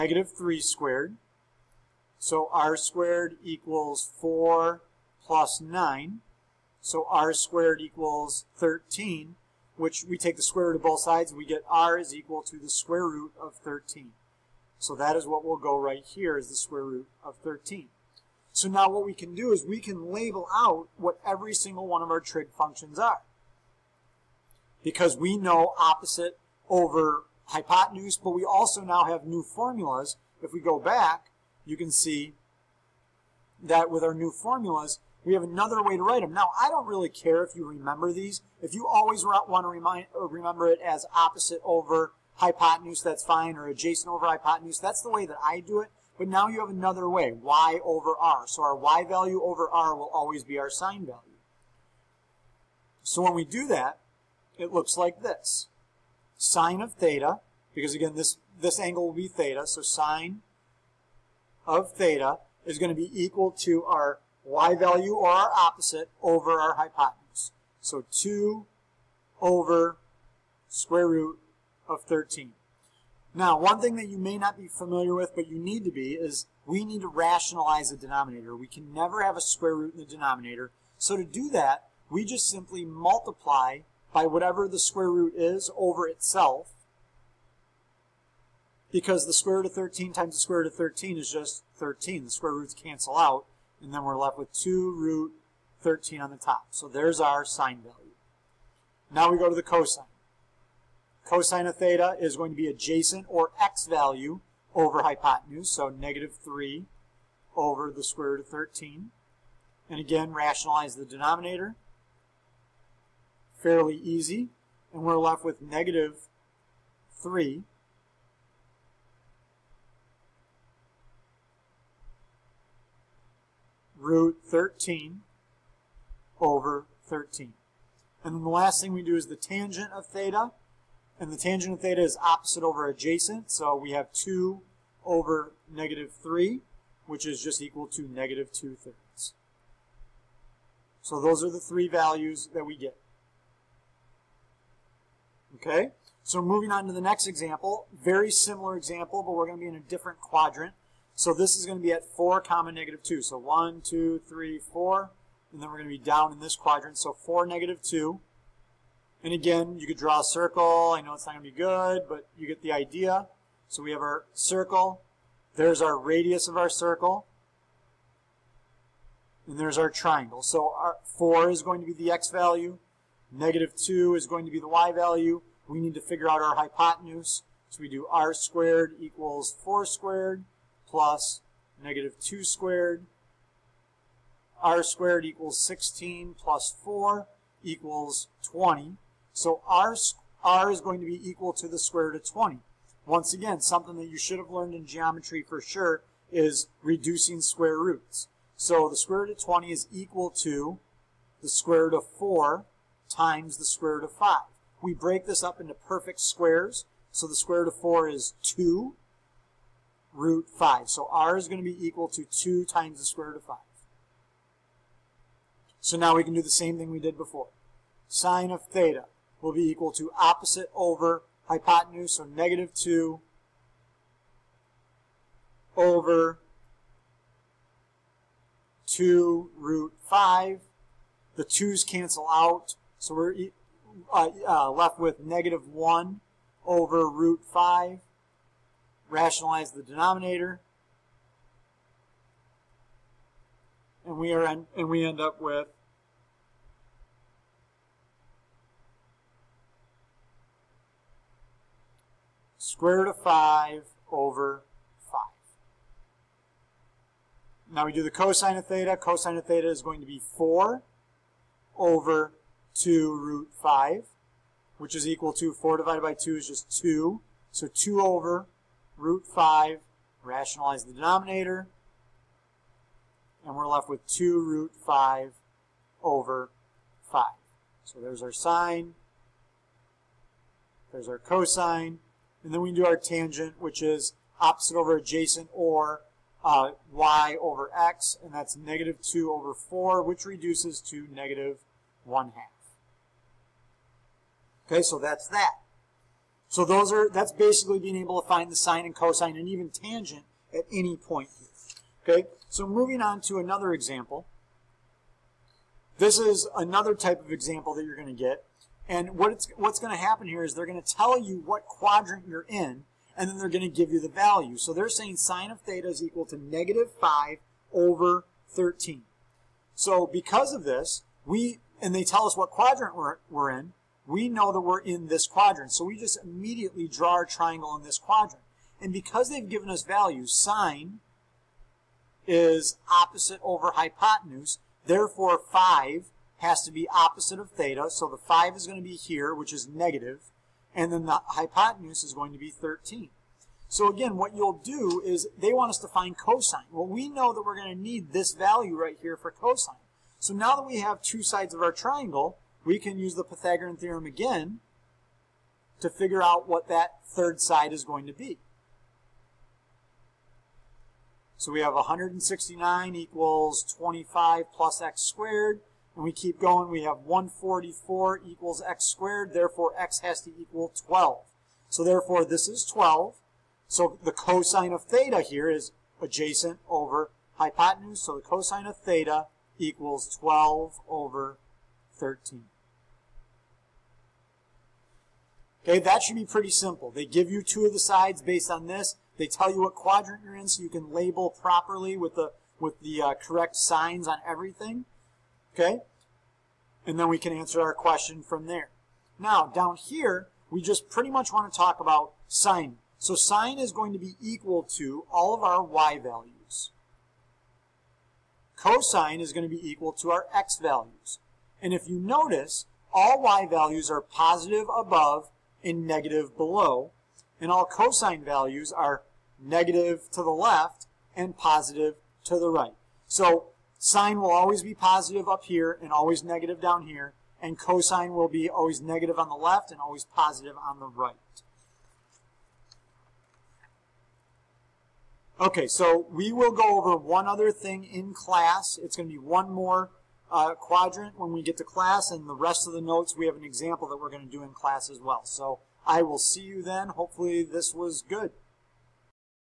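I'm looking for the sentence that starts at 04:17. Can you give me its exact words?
Now we do the cosine of theta.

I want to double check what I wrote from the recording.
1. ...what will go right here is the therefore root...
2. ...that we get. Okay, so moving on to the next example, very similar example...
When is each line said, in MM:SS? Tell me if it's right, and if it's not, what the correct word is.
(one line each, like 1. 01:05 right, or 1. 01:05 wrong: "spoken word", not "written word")
1. 00:15 wrong: "square", not "therefore"
2. 02:22 right.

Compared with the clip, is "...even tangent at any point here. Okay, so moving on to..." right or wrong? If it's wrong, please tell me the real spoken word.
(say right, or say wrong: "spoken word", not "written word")
right.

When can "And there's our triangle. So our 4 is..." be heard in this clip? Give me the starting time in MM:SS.
02:49.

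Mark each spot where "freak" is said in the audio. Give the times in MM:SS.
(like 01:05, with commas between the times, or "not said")
not said.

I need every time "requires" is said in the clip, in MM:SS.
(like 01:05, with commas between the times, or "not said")
not said.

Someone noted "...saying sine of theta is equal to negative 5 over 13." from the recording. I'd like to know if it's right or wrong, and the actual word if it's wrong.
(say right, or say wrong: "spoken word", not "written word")
right.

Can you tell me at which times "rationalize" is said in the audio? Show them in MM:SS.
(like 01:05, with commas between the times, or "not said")
01:17, 01:50, 03:59, 04:30.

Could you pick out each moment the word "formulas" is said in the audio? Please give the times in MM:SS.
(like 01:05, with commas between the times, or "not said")
00:29, 00:34.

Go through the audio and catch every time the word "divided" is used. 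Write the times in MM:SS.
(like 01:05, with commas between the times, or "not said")
04:25.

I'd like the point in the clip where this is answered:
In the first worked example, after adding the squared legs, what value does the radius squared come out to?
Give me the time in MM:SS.
00:07.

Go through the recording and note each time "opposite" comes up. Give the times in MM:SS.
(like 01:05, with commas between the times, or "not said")
00:25, 00:41, 01:05, 02:12, 03:40, 04:44, 05:32, 05:36.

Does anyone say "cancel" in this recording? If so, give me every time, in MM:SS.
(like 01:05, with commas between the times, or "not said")
01:32, 03:51.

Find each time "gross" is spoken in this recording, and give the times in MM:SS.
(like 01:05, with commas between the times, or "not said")
not said.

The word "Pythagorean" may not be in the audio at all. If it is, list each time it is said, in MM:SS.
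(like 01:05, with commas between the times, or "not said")
05:53.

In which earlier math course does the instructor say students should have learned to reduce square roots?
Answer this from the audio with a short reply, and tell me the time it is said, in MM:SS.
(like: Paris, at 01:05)
geometry, at 03:14.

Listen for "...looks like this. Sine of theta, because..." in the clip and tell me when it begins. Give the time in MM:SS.
00:54.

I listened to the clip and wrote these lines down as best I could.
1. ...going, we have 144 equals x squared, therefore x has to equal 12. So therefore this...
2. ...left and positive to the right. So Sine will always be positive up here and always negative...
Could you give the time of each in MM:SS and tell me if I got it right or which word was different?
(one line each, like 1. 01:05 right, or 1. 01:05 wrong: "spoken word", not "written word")
1. 06:06 right
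2. 07:00 right.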